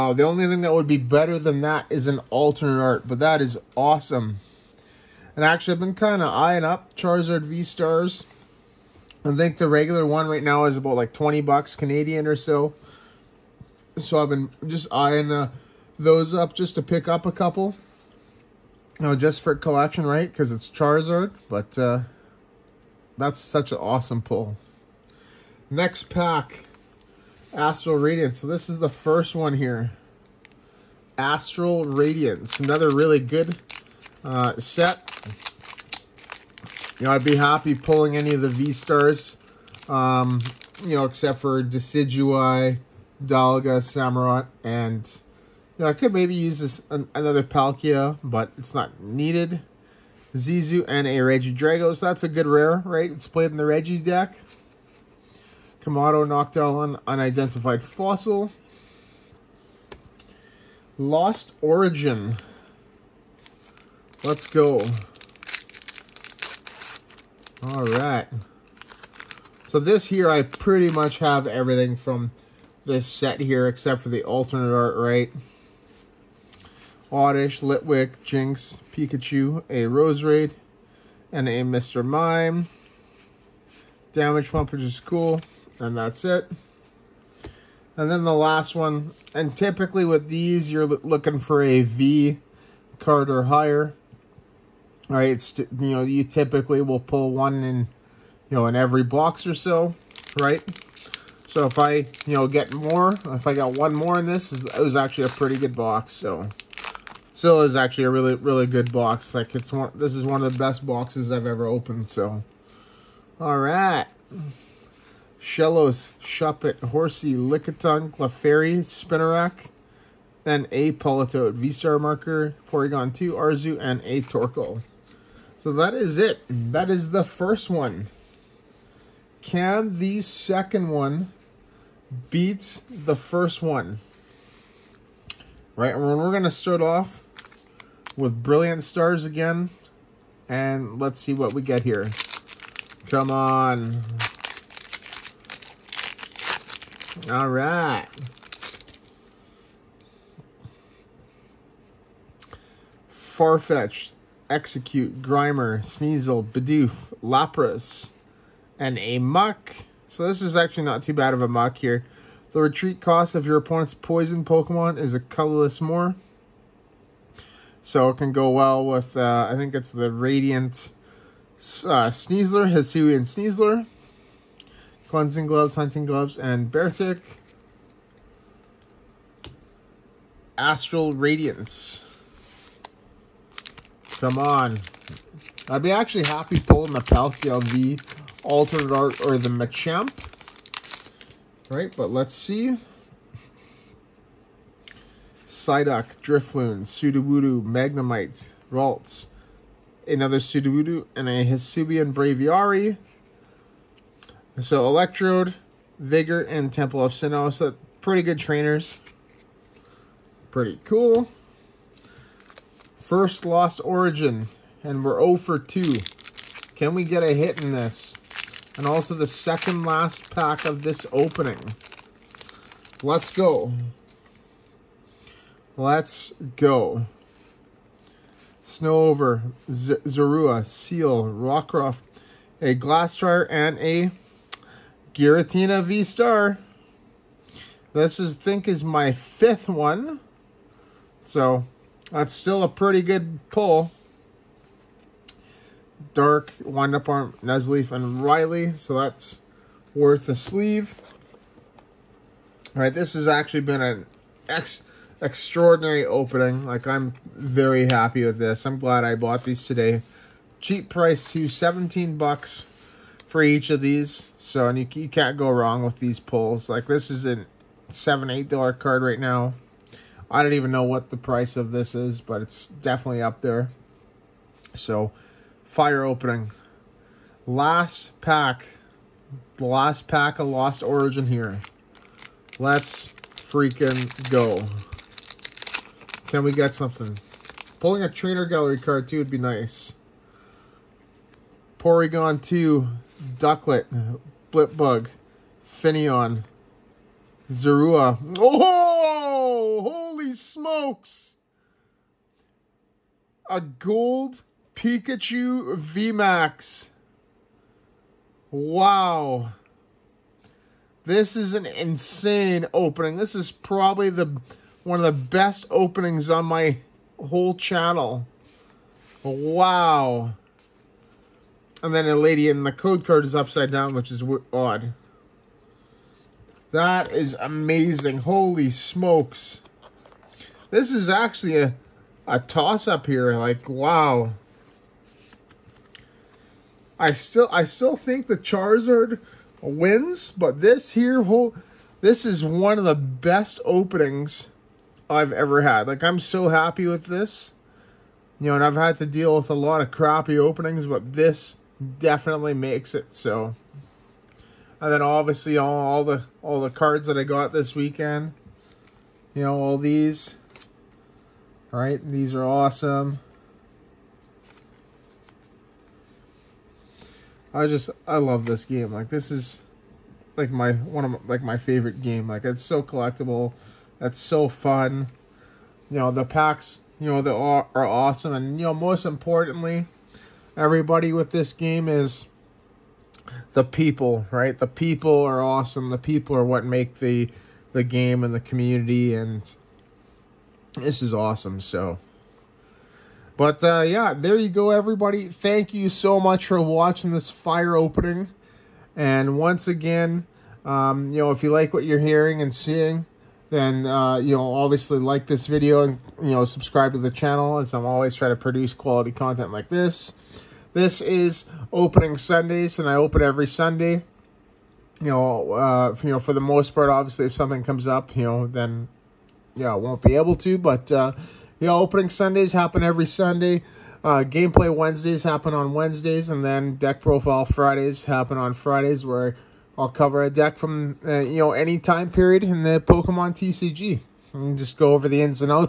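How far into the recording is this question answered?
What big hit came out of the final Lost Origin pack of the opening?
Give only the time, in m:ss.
5:03.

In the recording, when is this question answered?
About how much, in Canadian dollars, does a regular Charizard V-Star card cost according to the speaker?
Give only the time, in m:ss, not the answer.
0:11.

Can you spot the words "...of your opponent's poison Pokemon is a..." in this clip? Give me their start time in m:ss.
2:43.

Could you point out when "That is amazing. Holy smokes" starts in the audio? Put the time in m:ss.
5:26.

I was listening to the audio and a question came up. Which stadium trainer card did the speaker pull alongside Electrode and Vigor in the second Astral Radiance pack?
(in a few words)
Temple of Sinnoh.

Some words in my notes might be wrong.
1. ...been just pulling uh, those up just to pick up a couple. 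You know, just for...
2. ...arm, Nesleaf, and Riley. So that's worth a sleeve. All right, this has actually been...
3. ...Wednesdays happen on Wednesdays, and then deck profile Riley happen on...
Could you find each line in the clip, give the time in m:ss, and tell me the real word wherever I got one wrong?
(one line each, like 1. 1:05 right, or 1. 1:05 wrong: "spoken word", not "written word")
1. 0:14 wrong: "eyeing", not "pulling"
2. 4:07 right
3. 7:04 wrong: "Fridays", not "Riley".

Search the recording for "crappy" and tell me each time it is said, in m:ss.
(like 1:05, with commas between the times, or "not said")
5:49.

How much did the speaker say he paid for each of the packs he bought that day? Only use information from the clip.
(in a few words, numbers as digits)
17 bucks.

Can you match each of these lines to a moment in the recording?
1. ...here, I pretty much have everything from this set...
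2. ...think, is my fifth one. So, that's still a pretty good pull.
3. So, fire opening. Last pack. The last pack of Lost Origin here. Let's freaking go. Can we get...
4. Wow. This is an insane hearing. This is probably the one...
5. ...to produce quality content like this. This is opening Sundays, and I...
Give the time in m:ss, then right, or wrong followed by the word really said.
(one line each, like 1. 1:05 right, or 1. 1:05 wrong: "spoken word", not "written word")
1. 1:10 right
2. 3:58 right
3. 4:34 right
4. 5:08 wrong: "opening", not "hearing"
5. 6:48 right.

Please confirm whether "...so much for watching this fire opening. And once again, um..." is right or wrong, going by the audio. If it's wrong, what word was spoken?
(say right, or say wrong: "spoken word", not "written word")
right.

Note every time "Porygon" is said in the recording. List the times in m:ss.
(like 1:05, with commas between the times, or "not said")
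2:02, 4:51.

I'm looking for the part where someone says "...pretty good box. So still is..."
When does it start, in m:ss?
1:45.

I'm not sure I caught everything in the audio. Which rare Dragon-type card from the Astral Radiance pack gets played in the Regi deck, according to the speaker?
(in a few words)
Regidrago.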